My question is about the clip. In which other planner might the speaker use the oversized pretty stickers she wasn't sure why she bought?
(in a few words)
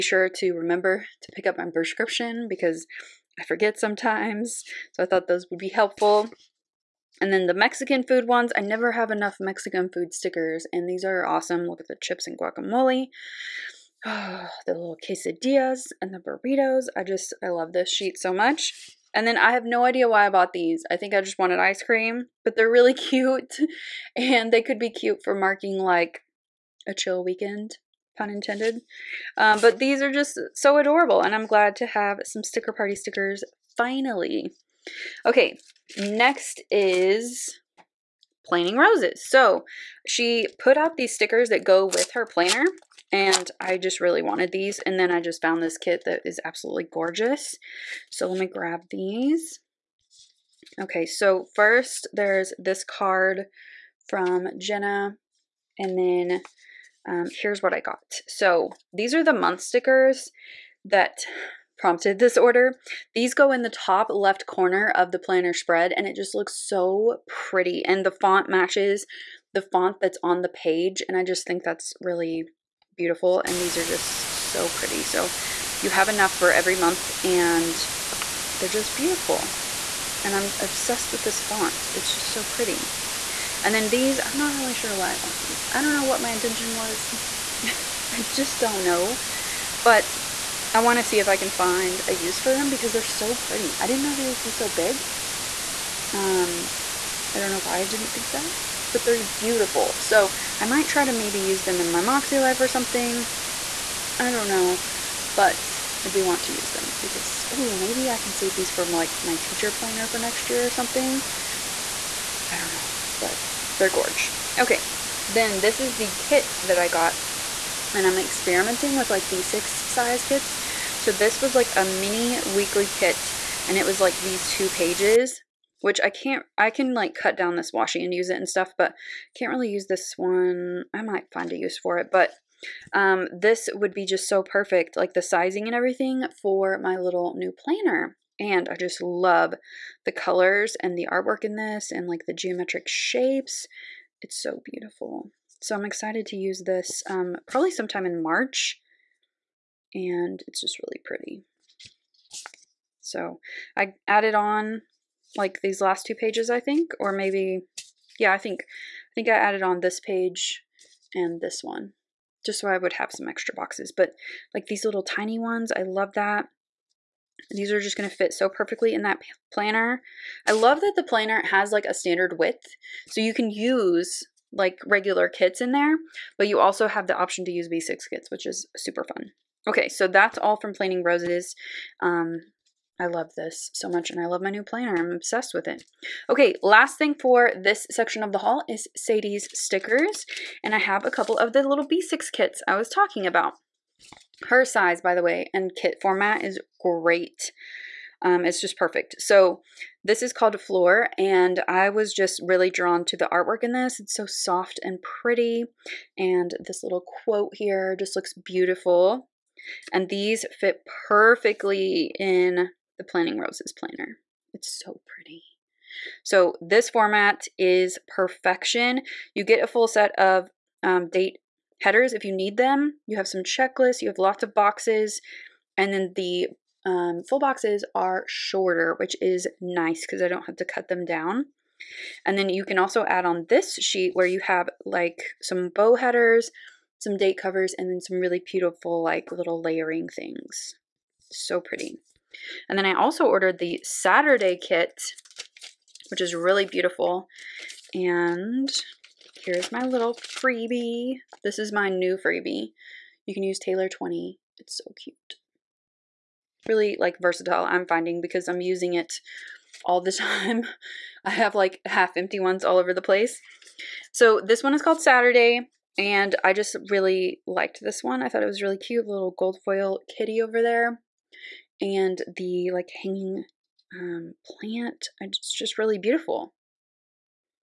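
Moxie Life.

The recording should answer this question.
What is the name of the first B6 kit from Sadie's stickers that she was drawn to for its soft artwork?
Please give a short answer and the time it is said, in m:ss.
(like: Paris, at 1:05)
Floor, at 3:20.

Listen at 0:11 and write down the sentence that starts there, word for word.
Look at the chips and guacamole.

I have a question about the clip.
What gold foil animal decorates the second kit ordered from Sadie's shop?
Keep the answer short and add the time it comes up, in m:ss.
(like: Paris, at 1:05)
kitty, at 4:30.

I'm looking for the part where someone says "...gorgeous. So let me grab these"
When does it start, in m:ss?
0:46.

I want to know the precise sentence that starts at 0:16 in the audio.
I just, I love this sheet so much.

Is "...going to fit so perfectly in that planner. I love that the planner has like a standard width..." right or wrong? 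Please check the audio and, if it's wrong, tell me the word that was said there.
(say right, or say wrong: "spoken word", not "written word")
right.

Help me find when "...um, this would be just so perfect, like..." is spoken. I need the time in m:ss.
2:12.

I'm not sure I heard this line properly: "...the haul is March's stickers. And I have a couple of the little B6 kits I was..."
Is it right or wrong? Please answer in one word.
wrong.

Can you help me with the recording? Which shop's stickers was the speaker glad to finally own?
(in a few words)
Sticker Party.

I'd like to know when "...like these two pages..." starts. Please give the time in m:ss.
2:04.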